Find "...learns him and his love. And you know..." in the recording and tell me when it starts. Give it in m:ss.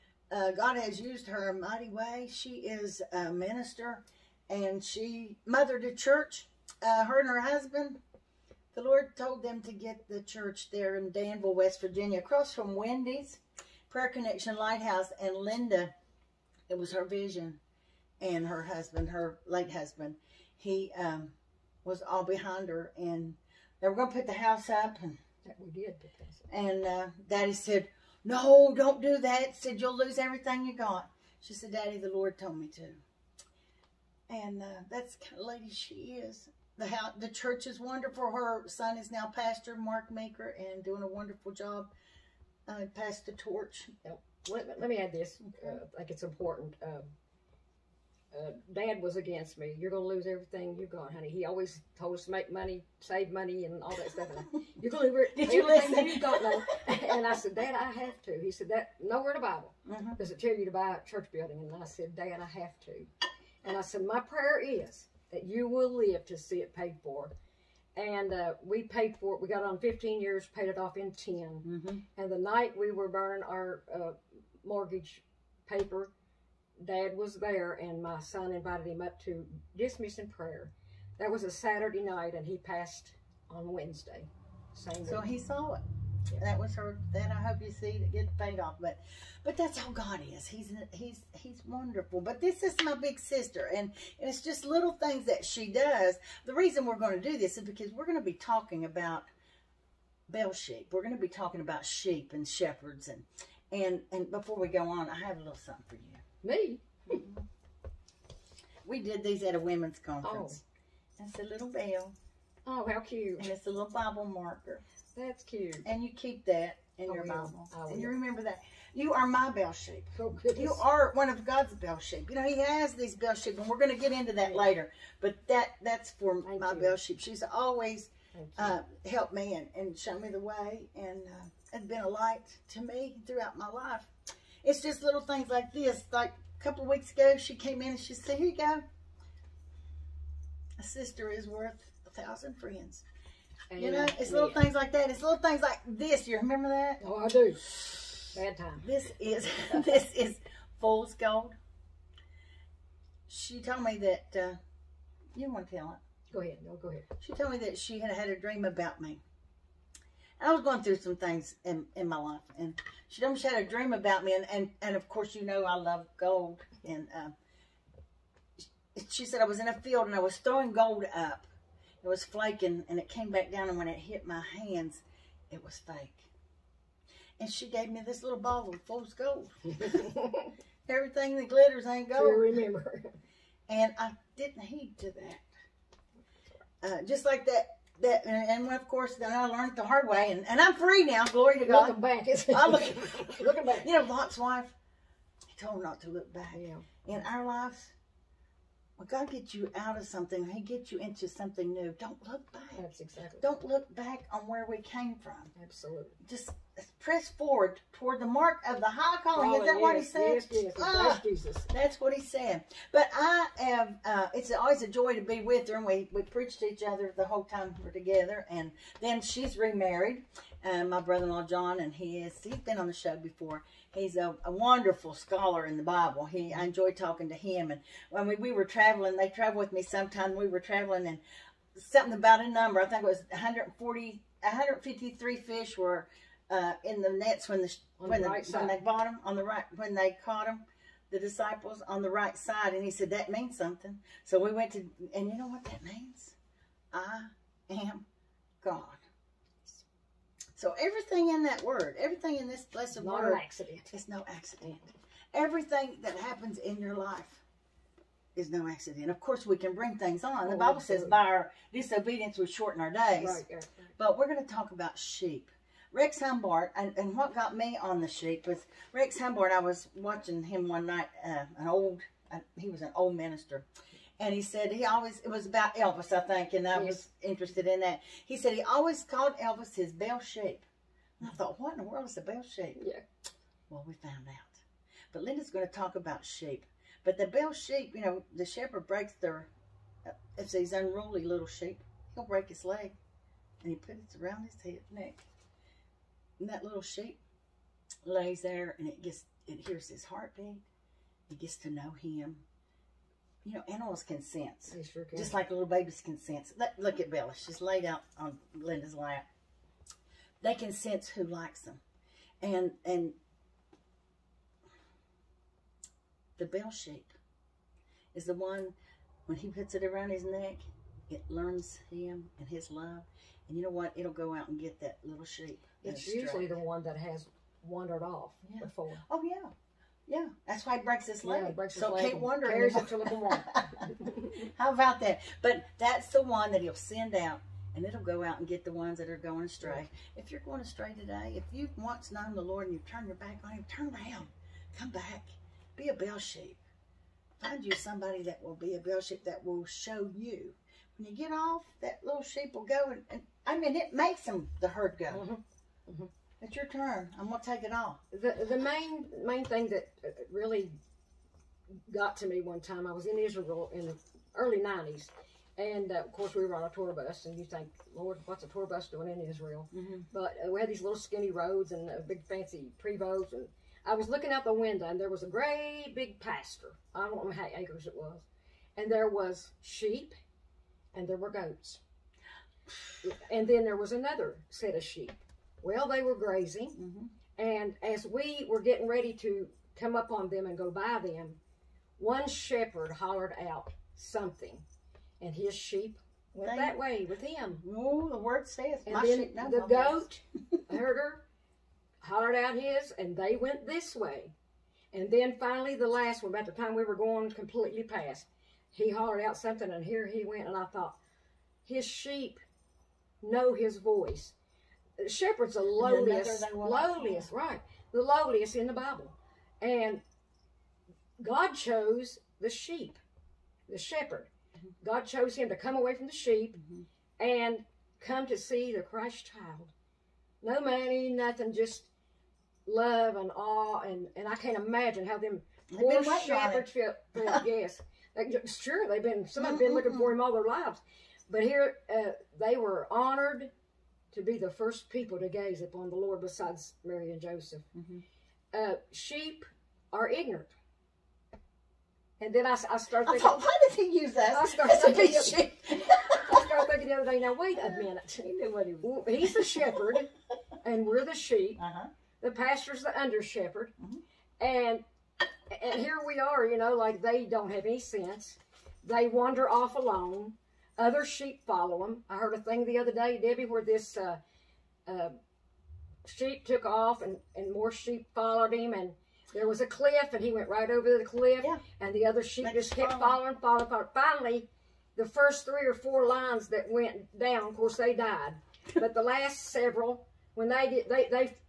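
5:21.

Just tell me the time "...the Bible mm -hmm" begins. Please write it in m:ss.
0:59.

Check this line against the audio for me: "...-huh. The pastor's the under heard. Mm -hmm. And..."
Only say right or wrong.
wrong.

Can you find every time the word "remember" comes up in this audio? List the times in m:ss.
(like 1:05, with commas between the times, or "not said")
1:58, 2:26, 3:02.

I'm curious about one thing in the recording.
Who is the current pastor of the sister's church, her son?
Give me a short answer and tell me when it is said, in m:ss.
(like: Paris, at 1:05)
Mark Maker, at 0:39.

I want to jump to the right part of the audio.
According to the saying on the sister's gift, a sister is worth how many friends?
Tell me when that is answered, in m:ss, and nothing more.
2:22.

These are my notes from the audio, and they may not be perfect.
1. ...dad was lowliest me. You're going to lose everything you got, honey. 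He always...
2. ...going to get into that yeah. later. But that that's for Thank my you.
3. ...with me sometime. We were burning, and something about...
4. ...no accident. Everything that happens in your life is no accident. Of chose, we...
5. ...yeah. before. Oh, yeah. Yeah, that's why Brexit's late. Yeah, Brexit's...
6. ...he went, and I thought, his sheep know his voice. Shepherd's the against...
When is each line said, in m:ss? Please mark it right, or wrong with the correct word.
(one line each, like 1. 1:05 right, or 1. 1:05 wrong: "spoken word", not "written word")
1. 0:48 wrong: "against", not "lowliest"
2. 2:03 right
3. 3:49 wrong: "traveling", not "burning"
4. 4:14 wrong: "course", not "chose"
5. 5:28 right
6. 6:50 wrong: "lowliest", not "against".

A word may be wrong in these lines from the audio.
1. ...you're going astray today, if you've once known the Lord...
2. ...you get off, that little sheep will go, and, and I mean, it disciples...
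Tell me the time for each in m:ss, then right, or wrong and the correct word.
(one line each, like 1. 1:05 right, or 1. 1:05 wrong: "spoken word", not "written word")
1. 5:40 right
2. 5:51 wrong: "makes", not "disciples".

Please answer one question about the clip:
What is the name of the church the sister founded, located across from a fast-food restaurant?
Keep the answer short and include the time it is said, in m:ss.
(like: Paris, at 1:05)
Prayer Connection Lighthouse, at 0:13.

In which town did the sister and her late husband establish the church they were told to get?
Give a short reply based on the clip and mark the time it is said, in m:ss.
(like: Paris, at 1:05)
Danville, West Virginia, at 0:11.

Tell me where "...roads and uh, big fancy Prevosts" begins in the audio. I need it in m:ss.
6:11.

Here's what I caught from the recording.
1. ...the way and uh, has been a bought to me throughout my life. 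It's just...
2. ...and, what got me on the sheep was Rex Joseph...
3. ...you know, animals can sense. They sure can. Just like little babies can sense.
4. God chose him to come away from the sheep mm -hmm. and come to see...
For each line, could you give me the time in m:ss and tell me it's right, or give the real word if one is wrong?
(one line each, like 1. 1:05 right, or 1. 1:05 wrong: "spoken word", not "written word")
1. 2:10 wrong: "light", not "bought"
2. 4:26 wrong: "Humbard", not "Joseph"
3. 5:03 right
4. 7:04 right.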